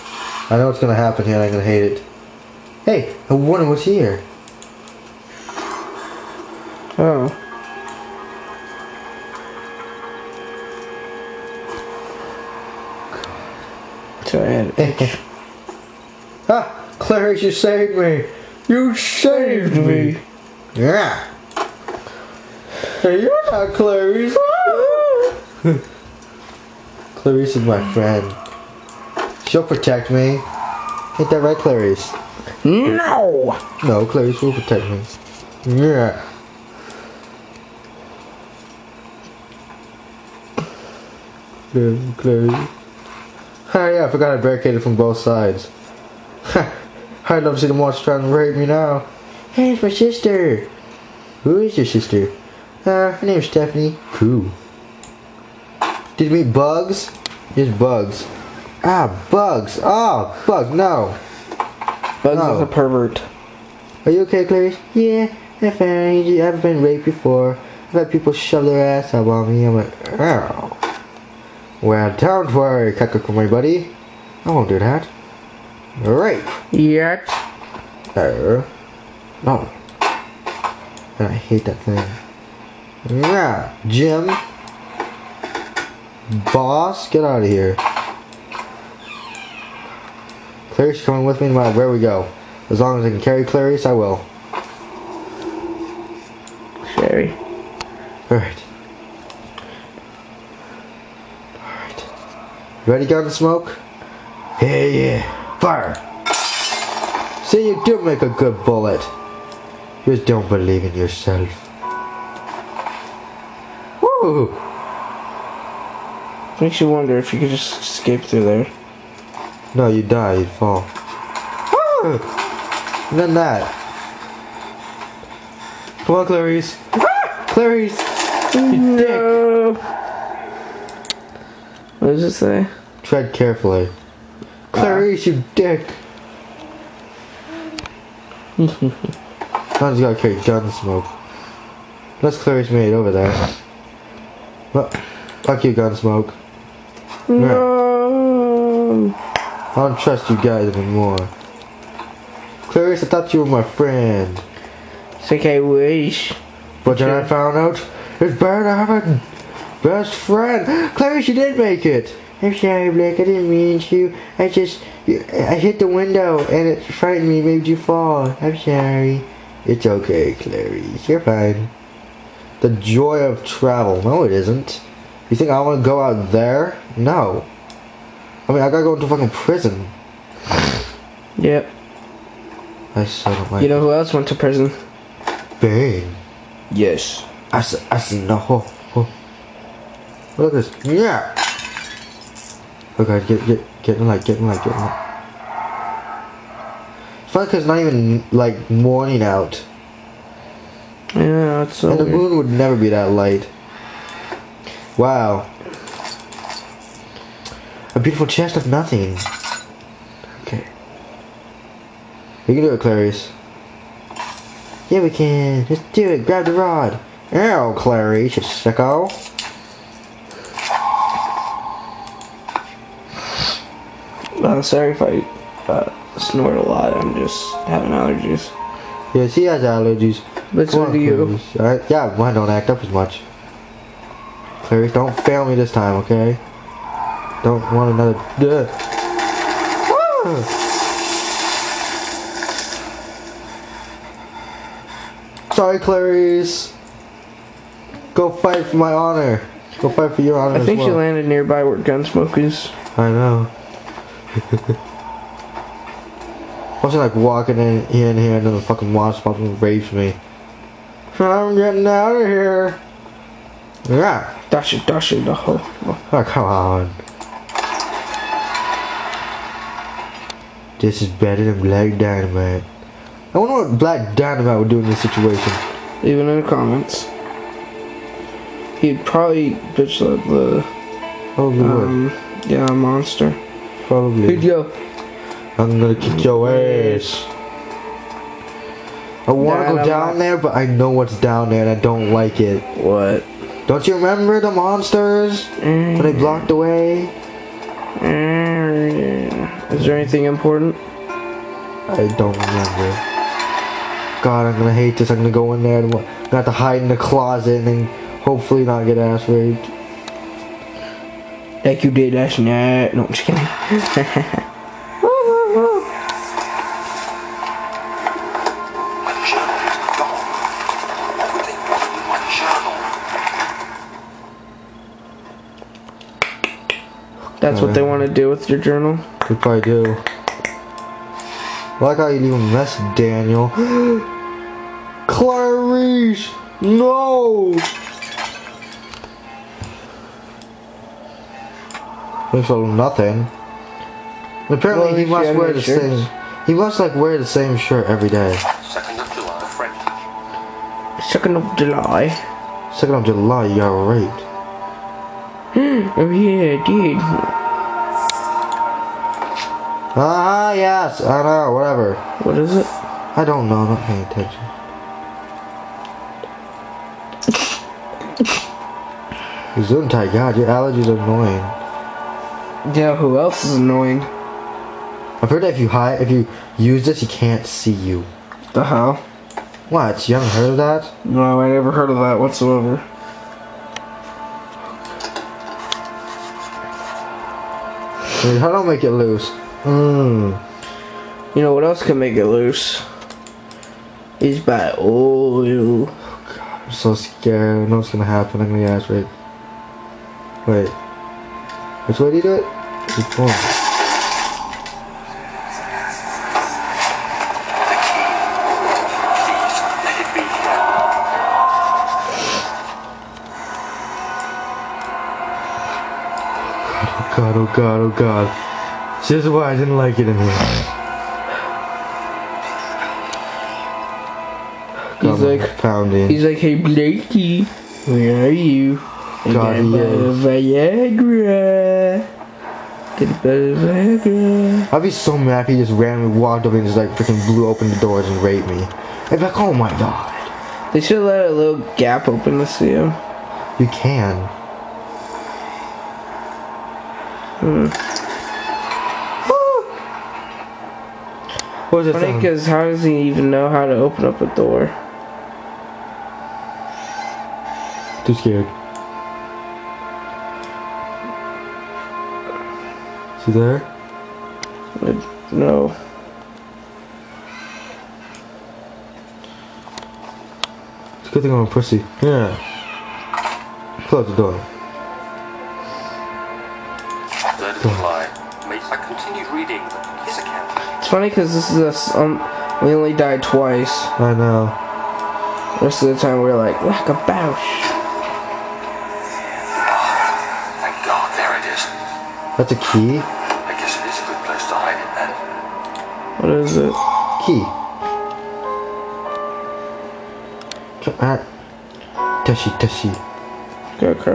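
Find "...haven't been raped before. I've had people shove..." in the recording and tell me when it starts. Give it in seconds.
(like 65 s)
66 s.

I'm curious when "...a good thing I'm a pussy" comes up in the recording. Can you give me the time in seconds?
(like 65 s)
471 s.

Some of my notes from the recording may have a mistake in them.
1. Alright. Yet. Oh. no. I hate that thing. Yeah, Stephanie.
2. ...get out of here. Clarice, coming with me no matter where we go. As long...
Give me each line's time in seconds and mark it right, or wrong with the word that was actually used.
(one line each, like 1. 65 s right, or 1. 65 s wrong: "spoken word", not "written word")
1. 76 s wrong: "Jim", not "Stephanie"
2. 87 s right.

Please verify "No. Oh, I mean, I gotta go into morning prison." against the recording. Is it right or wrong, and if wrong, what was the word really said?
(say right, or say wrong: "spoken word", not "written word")
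wrong: "fucking", not "morning".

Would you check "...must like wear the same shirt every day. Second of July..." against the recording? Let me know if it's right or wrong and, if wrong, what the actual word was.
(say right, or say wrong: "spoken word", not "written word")
right.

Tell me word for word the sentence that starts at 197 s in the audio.
it's not even, like, morning out.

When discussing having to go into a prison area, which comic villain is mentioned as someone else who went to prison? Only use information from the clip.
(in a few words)
Bane.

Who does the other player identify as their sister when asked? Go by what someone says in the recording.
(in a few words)
Stephanie.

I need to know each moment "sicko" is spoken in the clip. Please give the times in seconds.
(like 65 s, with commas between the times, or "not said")
218 s.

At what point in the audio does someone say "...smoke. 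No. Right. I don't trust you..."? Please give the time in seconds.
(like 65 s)
145 s.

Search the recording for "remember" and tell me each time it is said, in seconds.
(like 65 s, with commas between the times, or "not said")
294 s, 302 s.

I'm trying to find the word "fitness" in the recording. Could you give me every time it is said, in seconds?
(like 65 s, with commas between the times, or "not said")
not said.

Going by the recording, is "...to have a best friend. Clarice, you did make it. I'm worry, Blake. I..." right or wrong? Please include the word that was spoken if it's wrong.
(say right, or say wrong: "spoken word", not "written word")
wrong: "sorry", not "worry".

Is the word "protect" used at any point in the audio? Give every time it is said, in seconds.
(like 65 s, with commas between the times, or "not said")
29 s, 34 s.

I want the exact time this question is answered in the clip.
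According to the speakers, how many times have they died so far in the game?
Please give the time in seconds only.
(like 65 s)
483 s.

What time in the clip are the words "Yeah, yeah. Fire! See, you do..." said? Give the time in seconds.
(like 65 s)
104 s.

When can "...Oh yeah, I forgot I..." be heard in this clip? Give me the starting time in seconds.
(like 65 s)
43 s.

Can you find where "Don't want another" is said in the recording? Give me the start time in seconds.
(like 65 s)
237 s.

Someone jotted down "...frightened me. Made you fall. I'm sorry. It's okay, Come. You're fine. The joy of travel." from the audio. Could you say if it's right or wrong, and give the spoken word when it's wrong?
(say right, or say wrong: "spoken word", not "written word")
wrong: "Clarice", not "Come".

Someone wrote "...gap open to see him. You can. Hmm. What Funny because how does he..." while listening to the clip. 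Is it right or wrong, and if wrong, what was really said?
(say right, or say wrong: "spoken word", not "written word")
right.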